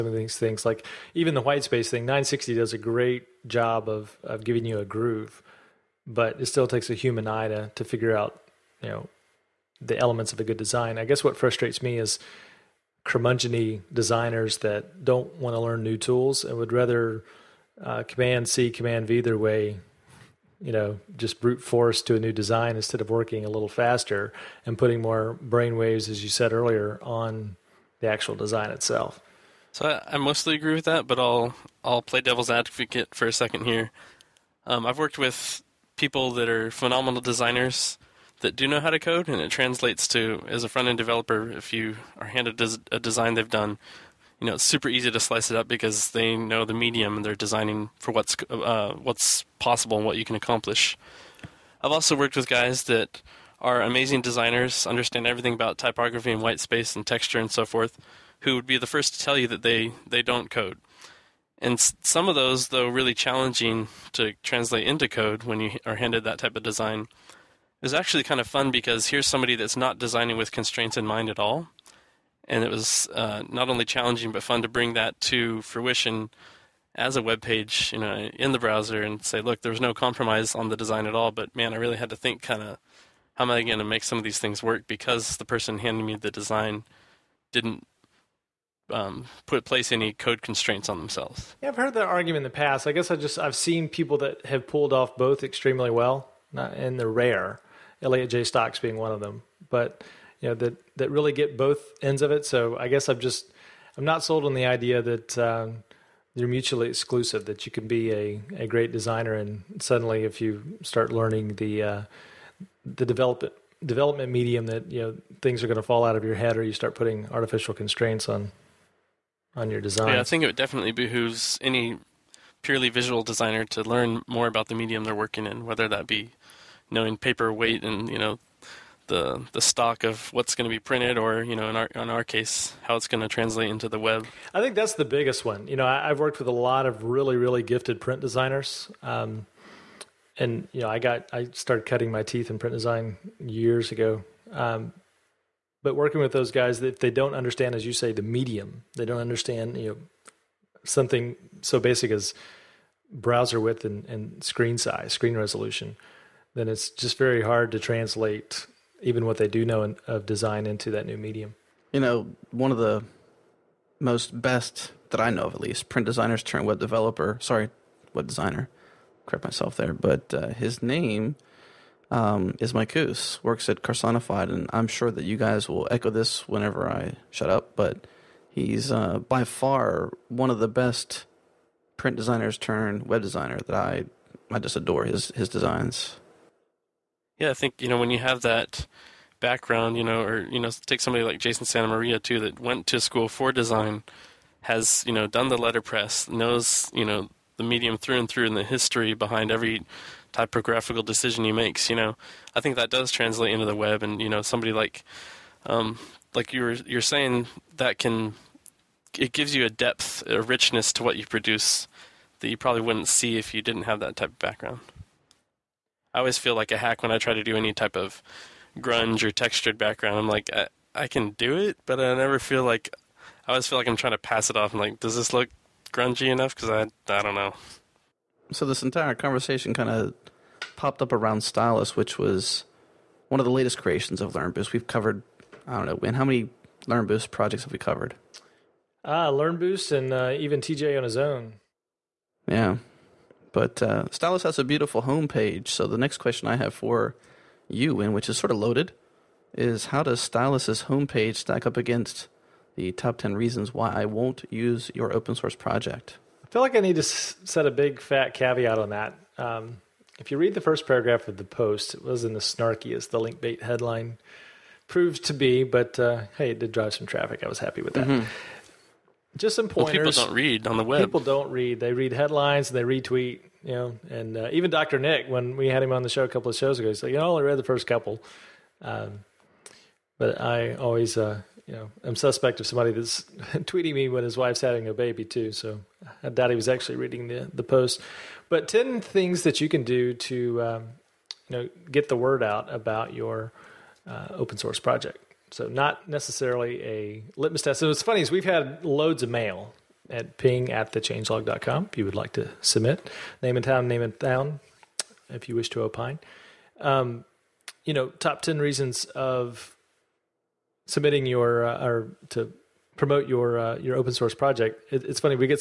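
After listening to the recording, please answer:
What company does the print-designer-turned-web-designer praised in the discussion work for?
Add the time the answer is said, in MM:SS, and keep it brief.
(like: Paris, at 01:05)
Carsonified, at 02:53.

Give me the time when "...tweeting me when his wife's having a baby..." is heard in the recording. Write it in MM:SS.
04:43.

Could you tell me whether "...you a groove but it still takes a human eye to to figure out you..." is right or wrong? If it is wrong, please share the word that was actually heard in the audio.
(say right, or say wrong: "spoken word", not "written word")
right.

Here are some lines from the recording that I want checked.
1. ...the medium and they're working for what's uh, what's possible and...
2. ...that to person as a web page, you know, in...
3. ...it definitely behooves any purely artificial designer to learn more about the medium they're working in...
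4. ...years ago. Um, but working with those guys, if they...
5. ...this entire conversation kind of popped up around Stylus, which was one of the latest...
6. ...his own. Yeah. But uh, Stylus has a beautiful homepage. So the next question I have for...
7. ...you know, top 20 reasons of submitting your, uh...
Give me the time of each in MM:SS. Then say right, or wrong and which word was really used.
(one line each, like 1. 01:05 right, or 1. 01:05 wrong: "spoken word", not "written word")
1. 00:46 wrong: "designing", not "working"
2. 01:14 wrong: "fruition", not "person"
3. 02:00 wrong: "visual", not "artificial"
4. 02:23 right
5. 03:48 right
6. 04:01 right
7. 05:07 wrong: "10", not "20".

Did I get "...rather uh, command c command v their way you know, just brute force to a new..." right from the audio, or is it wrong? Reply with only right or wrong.
right.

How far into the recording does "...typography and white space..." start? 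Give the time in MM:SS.
00:55.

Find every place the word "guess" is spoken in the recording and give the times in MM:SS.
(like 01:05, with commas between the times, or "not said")
00:11, 01:32, 01:42.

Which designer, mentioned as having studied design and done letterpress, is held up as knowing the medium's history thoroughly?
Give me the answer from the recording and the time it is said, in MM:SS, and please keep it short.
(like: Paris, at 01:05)
Jason Santa Maria, at 03:11.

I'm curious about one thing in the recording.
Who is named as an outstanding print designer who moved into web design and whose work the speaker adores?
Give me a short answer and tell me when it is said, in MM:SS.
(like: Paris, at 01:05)
Mike Kus, at 02:52.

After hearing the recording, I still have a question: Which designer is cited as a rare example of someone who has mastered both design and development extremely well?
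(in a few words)
Elliot Jay Stocks.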